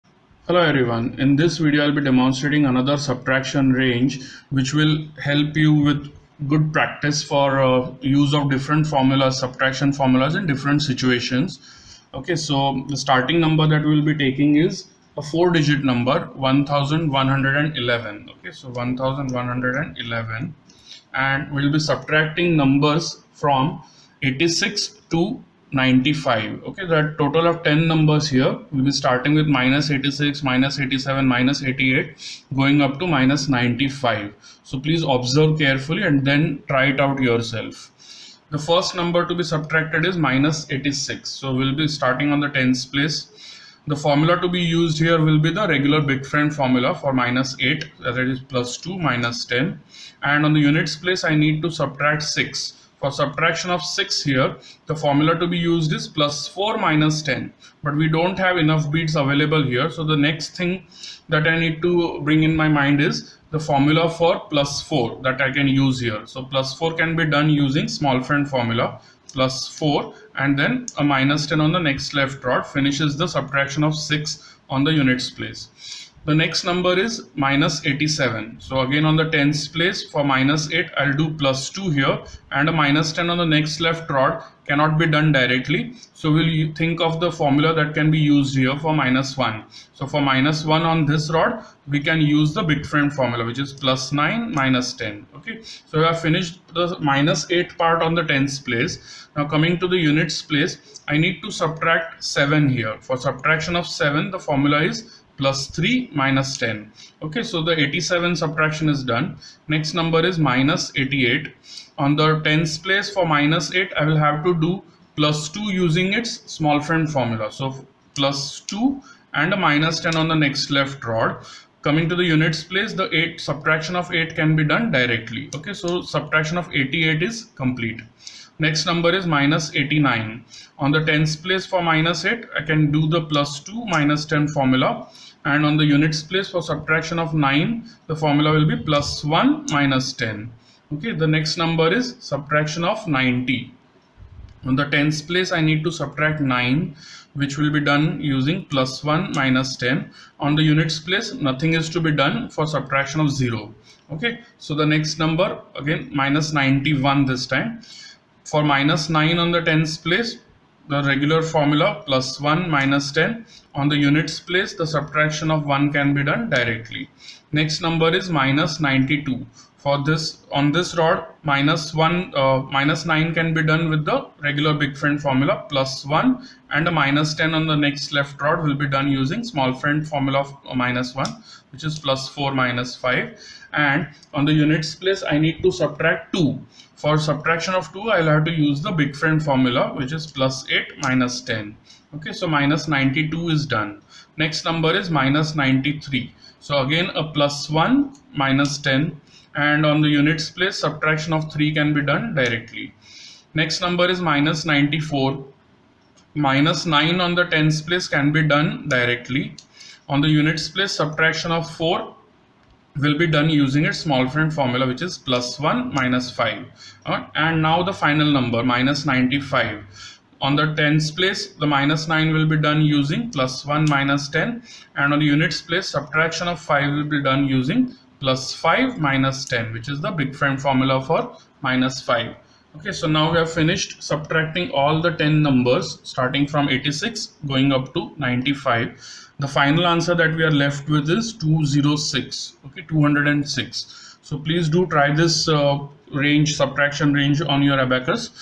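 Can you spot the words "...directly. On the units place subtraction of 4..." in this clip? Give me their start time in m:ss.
3:28.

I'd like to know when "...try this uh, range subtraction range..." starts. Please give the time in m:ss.
4:04.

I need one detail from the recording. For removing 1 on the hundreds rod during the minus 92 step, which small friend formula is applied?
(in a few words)
plus 4 minus 5.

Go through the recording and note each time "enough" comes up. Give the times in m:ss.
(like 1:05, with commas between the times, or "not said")
0:58.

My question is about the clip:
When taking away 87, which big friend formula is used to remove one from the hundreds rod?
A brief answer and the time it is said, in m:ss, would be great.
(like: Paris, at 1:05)
plus 9 minus 10, at 1:33.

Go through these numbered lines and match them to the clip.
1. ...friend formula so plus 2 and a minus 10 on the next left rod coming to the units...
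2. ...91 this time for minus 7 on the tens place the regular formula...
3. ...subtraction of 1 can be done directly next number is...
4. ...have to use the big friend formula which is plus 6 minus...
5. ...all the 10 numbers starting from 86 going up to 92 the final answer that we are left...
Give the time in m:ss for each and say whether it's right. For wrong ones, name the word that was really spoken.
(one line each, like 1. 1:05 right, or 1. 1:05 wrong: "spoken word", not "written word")
1. 1:56 right
2. 2:36 wrong: "9", not "7"
3. 2:44 right
4. 3:08 wrong: "8", not "6"
5. 3:54 wrong: "95", not "92".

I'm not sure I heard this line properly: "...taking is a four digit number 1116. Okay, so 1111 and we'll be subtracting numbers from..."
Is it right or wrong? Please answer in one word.
wrong.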